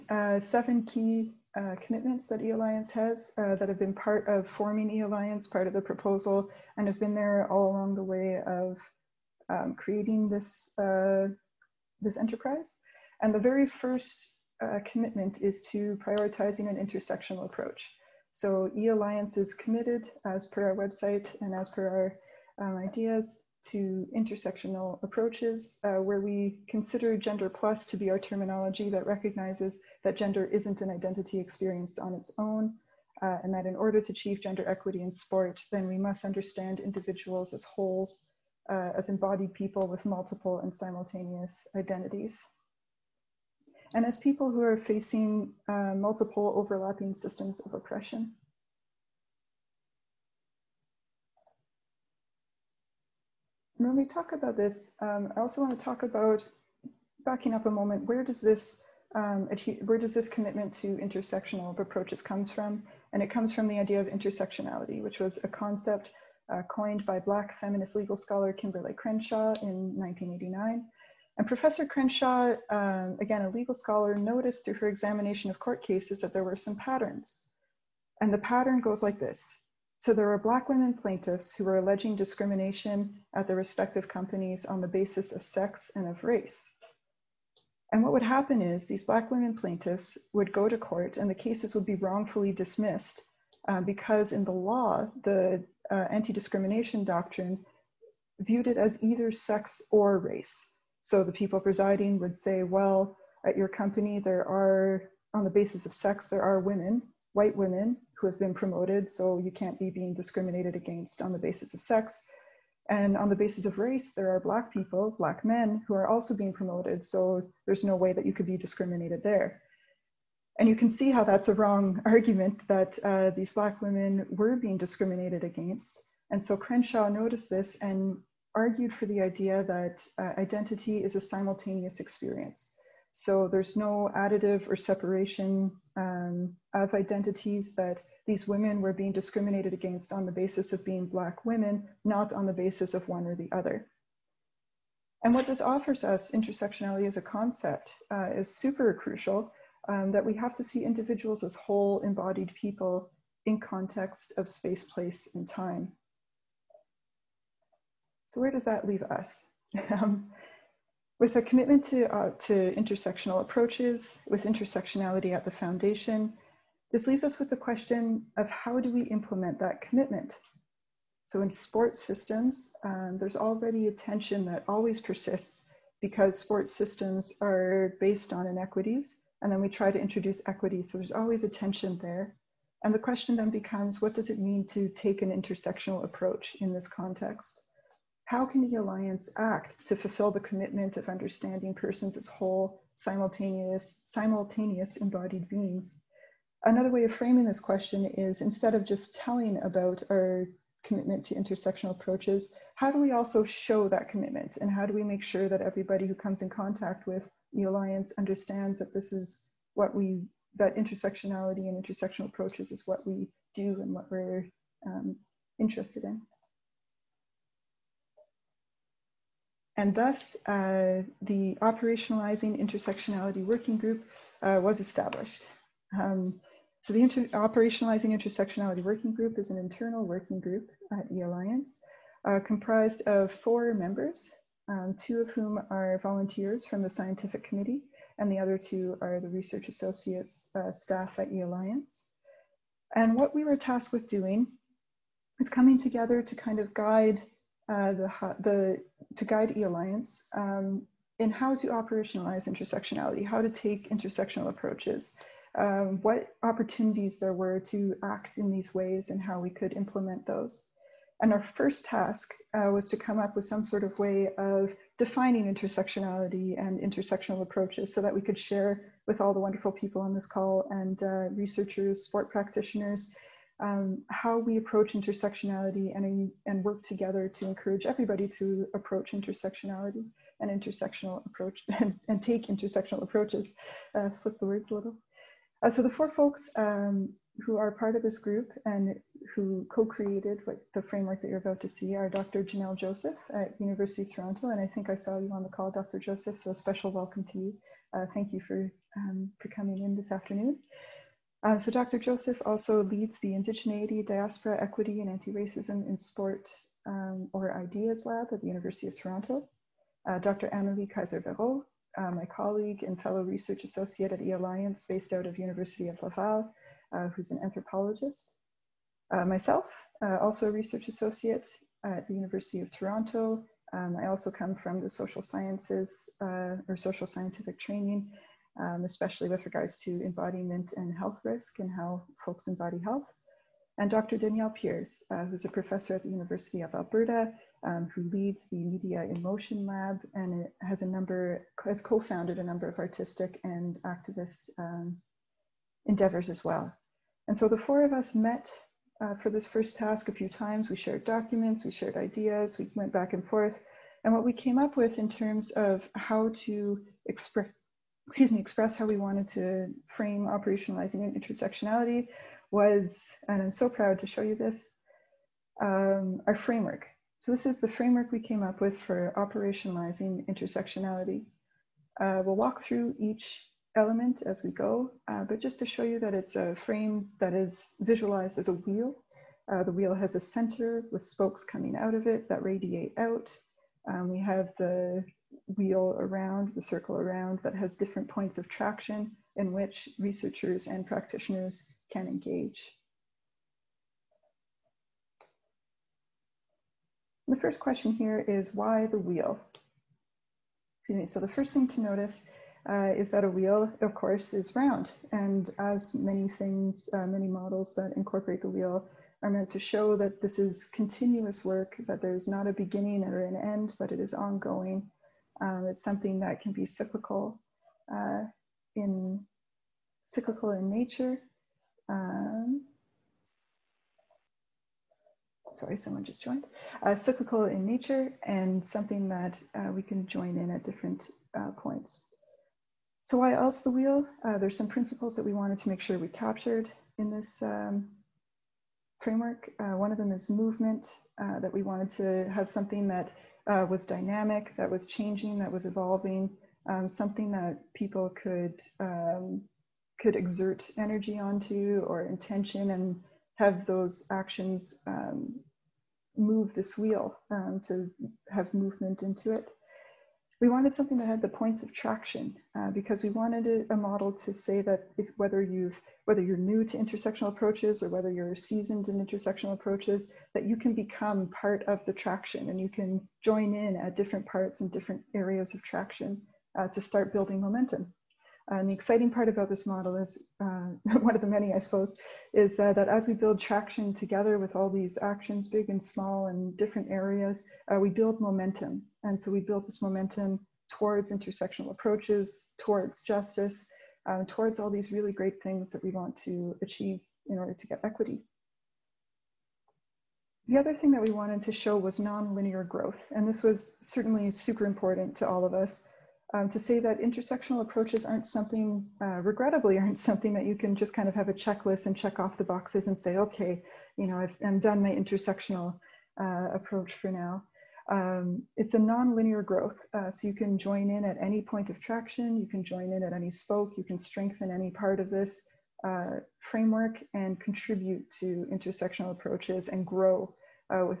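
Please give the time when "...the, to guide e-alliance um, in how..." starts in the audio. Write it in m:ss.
4:08.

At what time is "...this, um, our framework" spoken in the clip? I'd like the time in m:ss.
6:04.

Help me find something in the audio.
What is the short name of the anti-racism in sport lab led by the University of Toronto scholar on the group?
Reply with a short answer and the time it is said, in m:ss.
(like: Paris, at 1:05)
Ideas Lab, at 5:07.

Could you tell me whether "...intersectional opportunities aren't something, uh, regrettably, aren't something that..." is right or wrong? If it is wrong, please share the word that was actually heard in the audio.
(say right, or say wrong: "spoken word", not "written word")
wrong: "approaches", not "opportunities".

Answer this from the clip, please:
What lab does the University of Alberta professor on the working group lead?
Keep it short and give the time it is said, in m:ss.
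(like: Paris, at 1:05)
Media in Motion Lab, at 5:38.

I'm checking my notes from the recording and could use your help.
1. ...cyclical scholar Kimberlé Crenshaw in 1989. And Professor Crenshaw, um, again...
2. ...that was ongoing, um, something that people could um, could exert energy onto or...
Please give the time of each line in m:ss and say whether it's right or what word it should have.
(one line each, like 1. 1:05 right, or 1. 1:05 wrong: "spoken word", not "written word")
1. 1:07 wrong: "legal", not "cyclical"
2. 7:25 wrong: "evolving", not "ongoing".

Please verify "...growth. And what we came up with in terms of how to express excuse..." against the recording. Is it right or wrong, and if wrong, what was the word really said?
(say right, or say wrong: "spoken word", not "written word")
wrong: "forth", not "growth".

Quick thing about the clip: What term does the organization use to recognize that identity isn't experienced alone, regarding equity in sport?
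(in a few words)
gender plus.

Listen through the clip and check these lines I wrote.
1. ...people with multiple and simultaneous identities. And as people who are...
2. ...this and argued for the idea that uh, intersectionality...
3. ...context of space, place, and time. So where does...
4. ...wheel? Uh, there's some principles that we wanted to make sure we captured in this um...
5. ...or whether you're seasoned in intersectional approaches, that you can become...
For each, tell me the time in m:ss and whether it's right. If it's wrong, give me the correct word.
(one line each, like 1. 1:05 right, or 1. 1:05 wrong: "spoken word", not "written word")
1. 0:39 right
2. 2:07 wrong: "identity", not "intersectionality"
3. 2:33 right
4. 7:13 right
5. 7:47 right.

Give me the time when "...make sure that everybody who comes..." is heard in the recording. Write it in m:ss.
3:25.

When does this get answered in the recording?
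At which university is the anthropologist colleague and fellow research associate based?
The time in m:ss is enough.
5:15.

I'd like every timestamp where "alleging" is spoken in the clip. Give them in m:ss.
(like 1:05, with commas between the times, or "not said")
1:21.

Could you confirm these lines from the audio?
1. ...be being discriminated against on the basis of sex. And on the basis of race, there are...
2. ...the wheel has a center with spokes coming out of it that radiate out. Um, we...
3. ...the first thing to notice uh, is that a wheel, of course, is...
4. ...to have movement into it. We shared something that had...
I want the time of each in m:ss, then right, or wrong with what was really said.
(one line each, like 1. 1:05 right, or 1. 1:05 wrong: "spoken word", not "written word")
1. 1:49 right
2. 6:19 right
3. 6:41 right
4. 7:37 wrong: "wanted", not "shared".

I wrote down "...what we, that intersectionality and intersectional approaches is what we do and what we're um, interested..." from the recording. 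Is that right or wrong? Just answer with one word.
right.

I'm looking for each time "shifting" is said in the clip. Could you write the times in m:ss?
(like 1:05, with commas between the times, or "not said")
not said.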